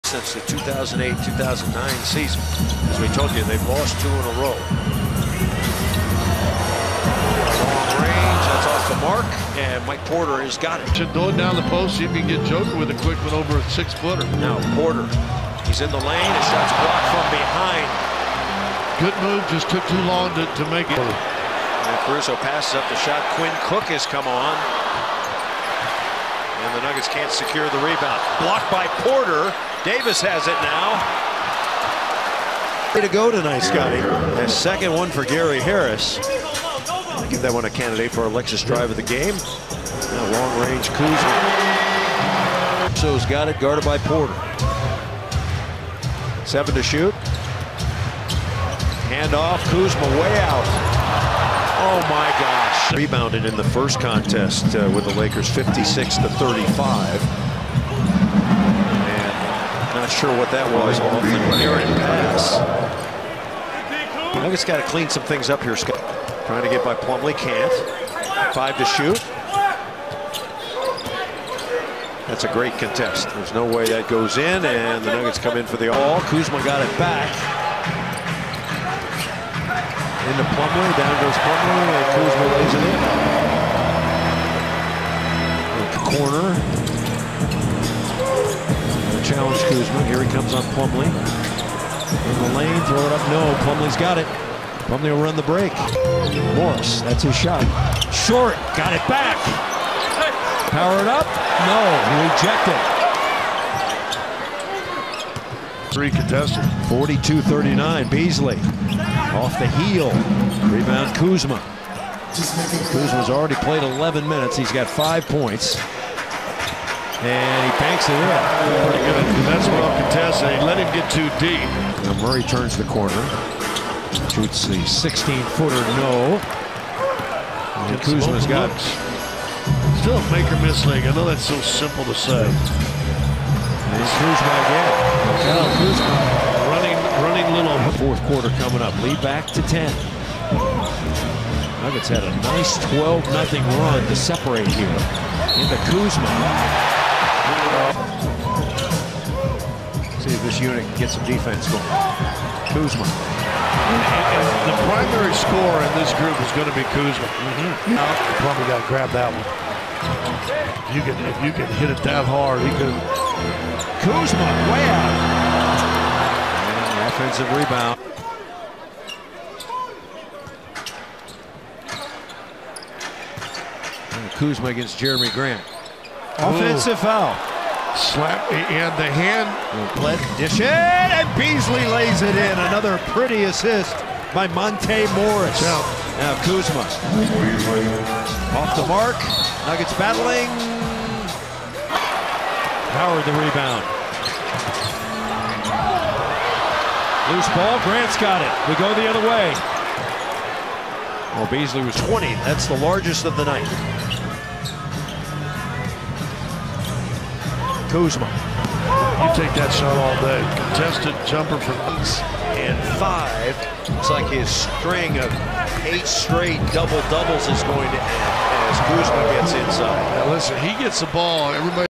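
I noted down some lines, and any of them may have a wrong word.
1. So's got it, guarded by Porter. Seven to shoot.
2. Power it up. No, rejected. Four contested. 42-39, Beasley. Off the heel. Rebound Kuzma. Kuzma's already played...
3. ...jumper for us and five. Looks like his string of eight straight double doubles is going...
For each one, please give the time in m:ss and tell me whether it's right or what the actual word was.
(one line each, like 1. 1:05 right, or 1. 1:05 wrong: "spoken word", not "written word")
1. 0:42 right
2. 1:40 wrong: "Three", not "Four"
3. 3:31 right.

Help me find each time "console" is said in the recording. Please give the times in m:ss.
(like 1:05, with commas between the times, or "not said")
not said.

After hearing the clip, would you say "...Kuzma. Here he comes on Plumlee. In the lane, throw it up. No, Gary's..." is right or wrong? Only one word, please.
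wrong.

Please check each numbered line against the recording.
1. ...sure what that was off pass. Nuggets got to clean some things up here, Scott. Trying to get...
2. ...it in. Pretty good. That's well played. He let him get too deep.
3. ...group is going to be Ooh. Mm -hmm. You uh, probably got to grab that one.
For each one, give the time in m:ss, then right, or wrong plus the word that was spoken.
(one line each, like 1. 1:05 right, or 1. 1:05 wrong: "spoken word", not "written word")
1. 1:00 right
2. 1:58 wrong: "contested", not "played"
3. 2:36 wrong: "Kuzma", not "Ooh".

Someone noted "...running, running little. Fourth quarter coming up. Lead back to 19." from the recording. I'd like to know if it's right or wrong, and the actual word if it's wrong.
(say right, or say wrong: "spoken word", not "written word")
wrong: "10", not "19".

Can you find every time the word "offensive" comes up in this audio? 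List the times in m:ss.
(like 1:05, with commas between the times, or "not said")
2:47, 2:56.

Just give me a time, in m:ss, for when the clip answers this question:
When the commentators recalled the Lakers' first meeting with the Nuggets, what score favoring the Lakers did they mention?
0:55.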